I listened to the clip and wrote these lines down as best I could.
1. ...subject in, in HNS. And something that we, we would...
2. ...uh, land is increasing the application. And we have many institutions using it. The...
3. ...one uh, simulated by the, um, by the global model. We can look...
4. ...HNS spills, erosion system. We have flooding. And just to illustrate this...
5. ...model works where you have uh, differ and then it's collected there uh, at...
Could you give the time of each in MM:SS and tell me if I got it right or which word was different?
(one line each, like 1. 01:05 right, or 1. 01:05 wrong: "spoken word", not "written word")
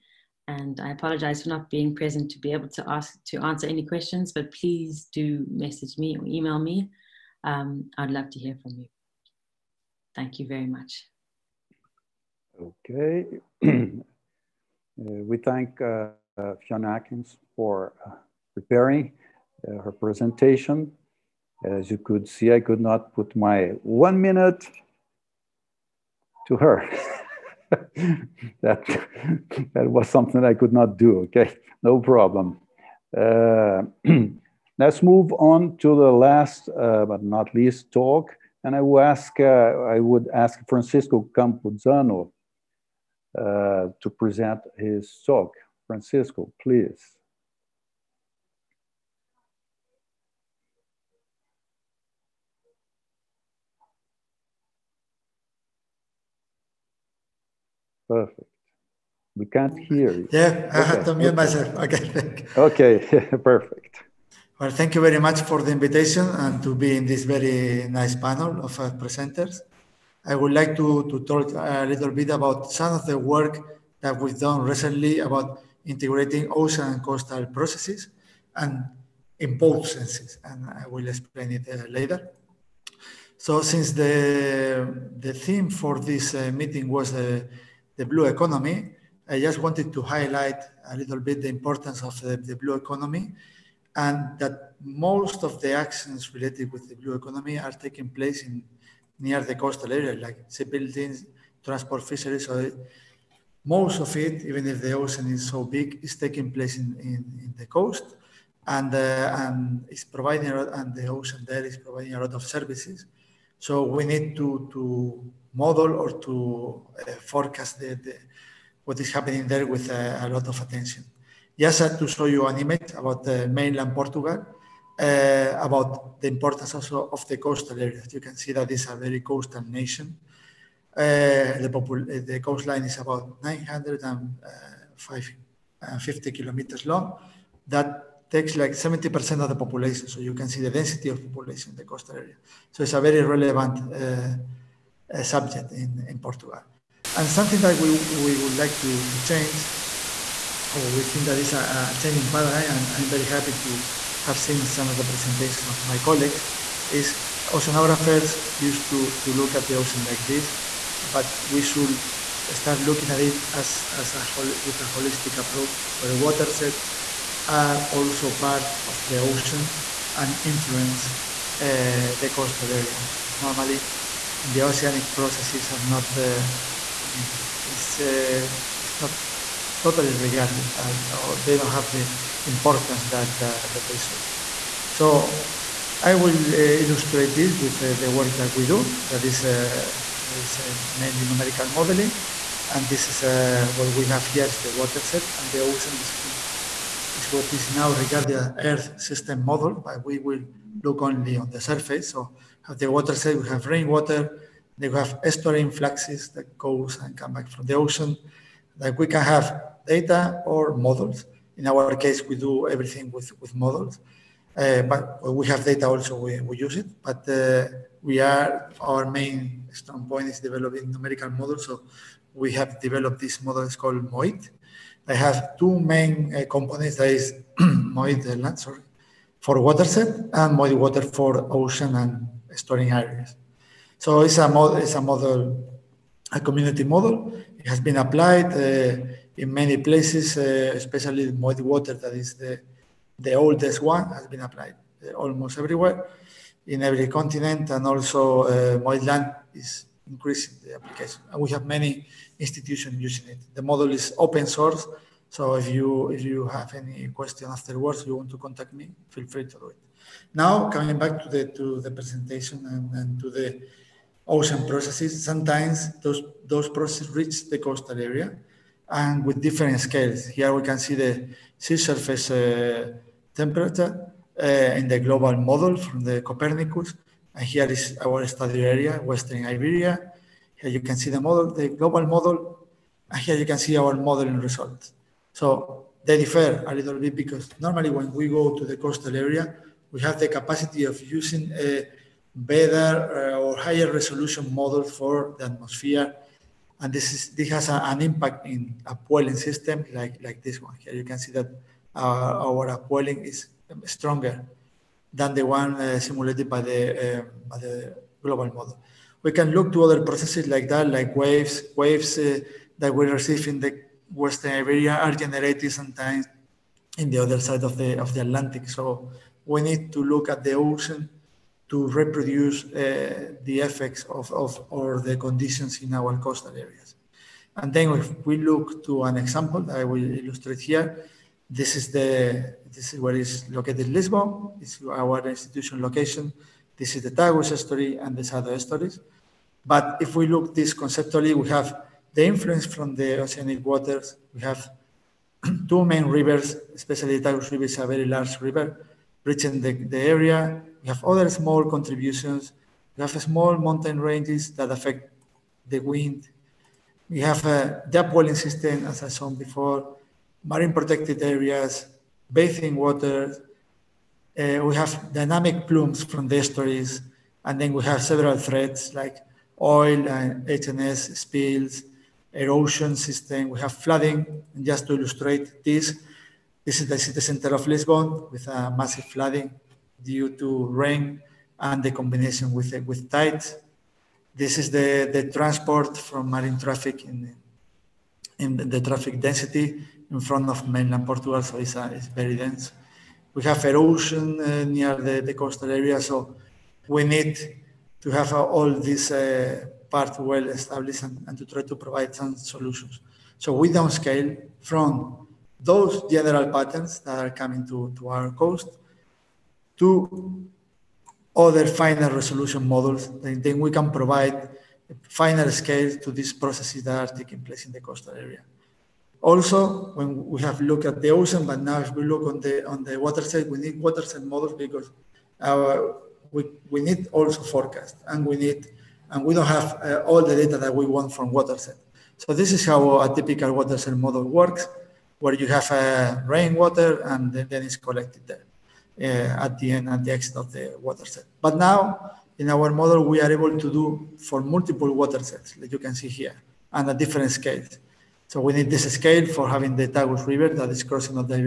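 1. 02:25 wrong: "Portugal", not "HNS"
2. 04:08 right
3. 05:05 right
4. 06:10 right
5. 07:13 wrong: "rainwater", not "differ".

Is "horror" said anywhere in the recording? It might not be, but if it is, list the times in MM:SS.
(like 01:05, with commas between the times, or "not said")
not said.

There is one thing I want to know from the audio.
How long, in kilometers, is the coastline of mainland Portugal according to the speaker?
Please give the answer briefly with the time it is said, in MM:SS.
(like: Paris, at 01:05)
950 kilometers, at 02:13.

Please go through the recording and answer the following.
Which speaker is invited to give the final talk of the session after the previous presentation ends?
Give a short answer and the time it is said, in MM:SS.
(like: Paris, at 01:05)
Francisco Campuzano, at 00:40.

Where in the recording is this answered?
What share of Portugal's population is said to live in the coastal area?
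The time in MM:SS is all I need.
02:18.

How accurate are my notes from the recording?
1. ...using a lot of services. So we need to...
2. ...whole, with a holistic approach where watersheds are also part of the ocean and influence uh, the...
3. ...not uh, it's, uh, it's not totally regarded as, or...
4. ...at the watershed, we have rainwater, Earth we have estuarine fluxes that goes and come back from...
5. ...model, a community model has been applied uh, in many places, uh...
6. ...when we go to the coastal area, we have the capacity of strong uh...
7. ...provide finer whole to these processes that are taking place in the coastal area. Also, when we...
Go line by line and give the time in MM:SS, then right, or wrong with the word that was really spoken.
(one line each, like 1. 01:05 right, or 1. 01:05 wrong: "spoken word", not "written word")
1. 01:51 wrong: "providing", not "using"
2. 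02:44 right
3. 02:55 right
4. 03:22 wrong: "They", not "Earth"
5. 03:55 right
6. 04:47 wrong: "using", not "strong"
7. 06:53 wrong: "scale", not "whole".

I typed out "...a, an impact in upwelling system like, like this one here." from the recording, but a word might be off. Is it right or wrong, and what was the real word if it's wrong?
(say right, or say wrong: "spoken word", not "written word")
right.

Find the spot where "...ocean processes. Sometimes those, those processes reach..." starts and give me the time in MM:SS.
04:24.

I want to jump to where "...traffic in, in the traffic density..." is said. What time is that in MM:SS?
06:26.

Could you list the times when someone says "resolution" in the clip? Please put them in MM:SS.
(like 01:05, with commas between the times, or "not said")
04:53, 06:52.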